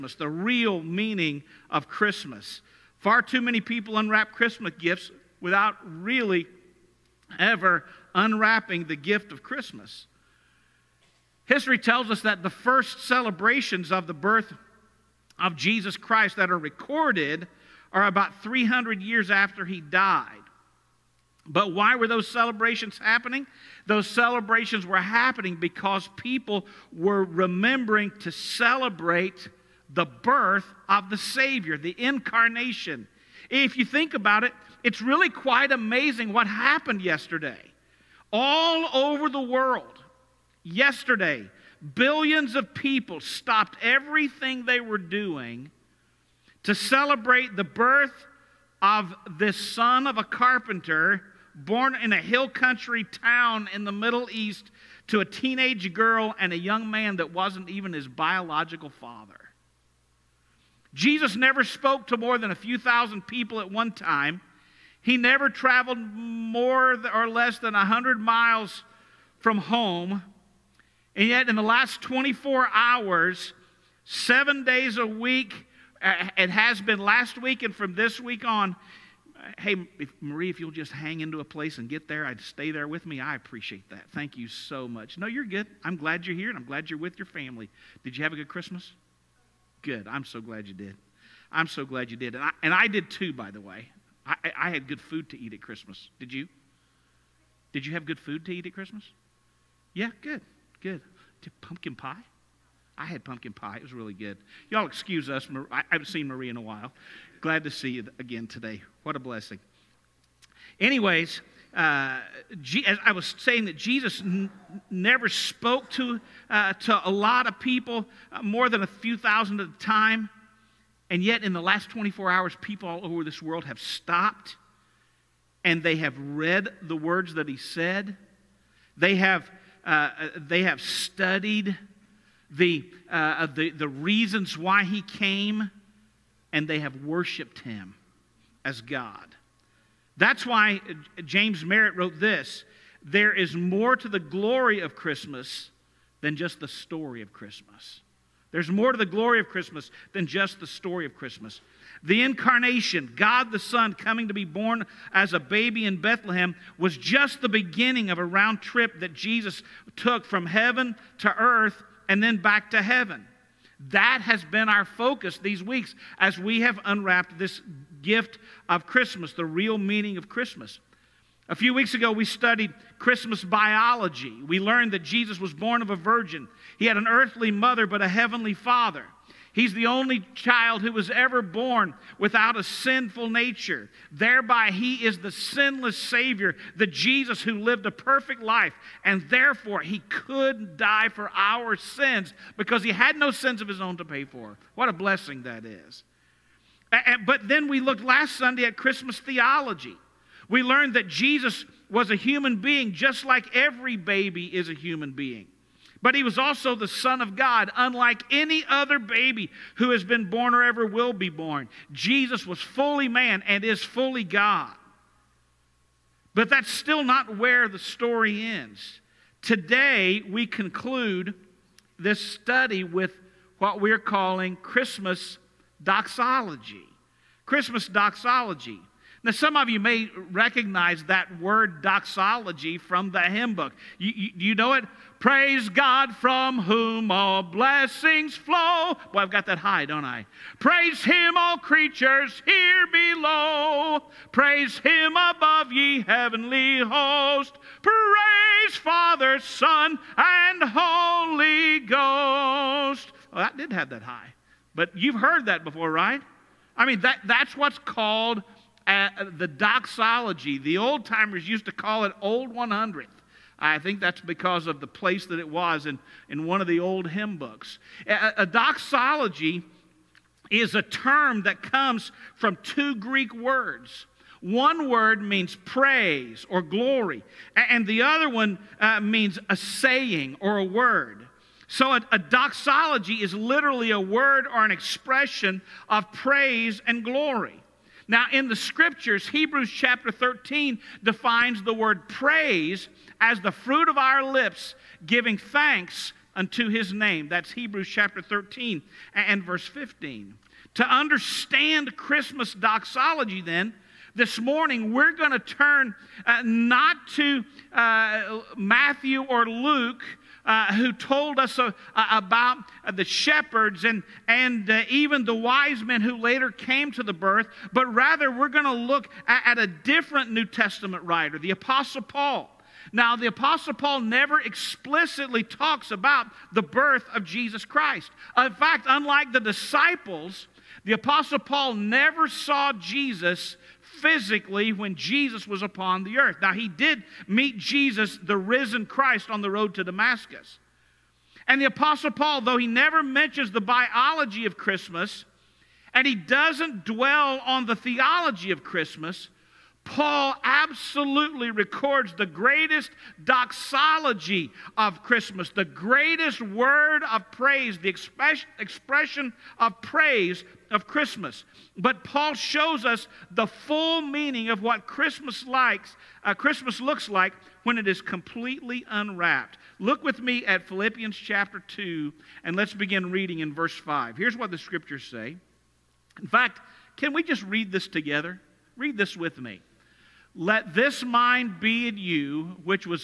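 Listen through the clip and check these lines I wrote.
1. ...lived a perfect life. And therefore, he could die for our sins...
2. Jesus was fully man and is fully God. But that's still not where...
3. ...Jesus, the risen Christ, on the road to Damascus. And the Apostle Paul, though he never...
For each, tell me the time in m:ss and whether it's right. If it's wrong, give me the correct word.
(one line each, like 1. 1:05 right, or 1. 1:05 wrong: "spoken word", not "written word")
1. 3:07 right
2. 3:31 right
3. 5:37 right.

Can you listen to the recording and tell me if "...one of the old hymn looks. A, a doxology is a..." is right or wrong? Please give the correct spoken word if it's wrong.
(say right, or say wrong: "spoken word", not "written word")
wrong: "books", not "looks".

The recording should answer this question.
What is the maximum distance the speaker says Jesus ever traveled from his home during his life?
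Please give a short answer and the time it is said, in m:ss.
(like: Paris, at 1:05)
100 miles, at 1:07.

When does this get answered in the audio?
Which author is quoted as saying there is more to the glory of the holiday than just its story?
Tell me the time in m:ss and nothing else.
2:21.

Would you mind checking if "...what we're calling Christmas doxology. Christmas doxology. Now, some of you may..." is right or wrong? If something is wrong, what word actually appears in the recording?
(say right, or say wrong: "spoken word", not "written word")
right.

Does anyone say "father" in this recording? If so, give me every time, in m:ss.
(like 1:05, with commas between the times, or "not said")
0:58, 2:58, 4:08.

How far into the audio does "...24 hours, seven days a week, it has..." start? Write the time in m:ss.
1:12.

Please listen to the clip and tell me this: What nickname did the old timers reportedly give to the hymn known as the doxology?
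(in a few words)
Old 100th.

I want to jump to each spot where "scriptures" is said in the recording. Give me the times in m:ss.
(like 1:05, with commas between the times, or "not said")
4:48, 6:14.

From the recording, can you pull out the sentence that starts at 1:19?
Hey, Marie, if you'll just hang into a place and get there, I'd stay there with me.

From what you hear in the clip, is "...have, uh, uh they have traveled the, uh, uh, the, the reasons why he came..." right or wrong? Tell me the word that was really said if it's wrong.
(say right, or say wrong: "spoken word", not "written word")
wrong: "studied", not "traveled".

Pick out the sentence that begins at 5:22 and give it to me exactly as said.
Now, the Apostle Paul never explicitly talks about the birth of Jesus Christ.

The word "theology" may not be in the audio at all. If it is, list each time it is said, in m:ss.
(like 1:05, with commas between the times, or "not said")
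3:19, 5:47.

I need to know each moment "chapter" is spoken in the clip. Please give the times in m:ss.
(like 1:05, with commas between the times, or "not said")
4:49, 4:57, 6:11.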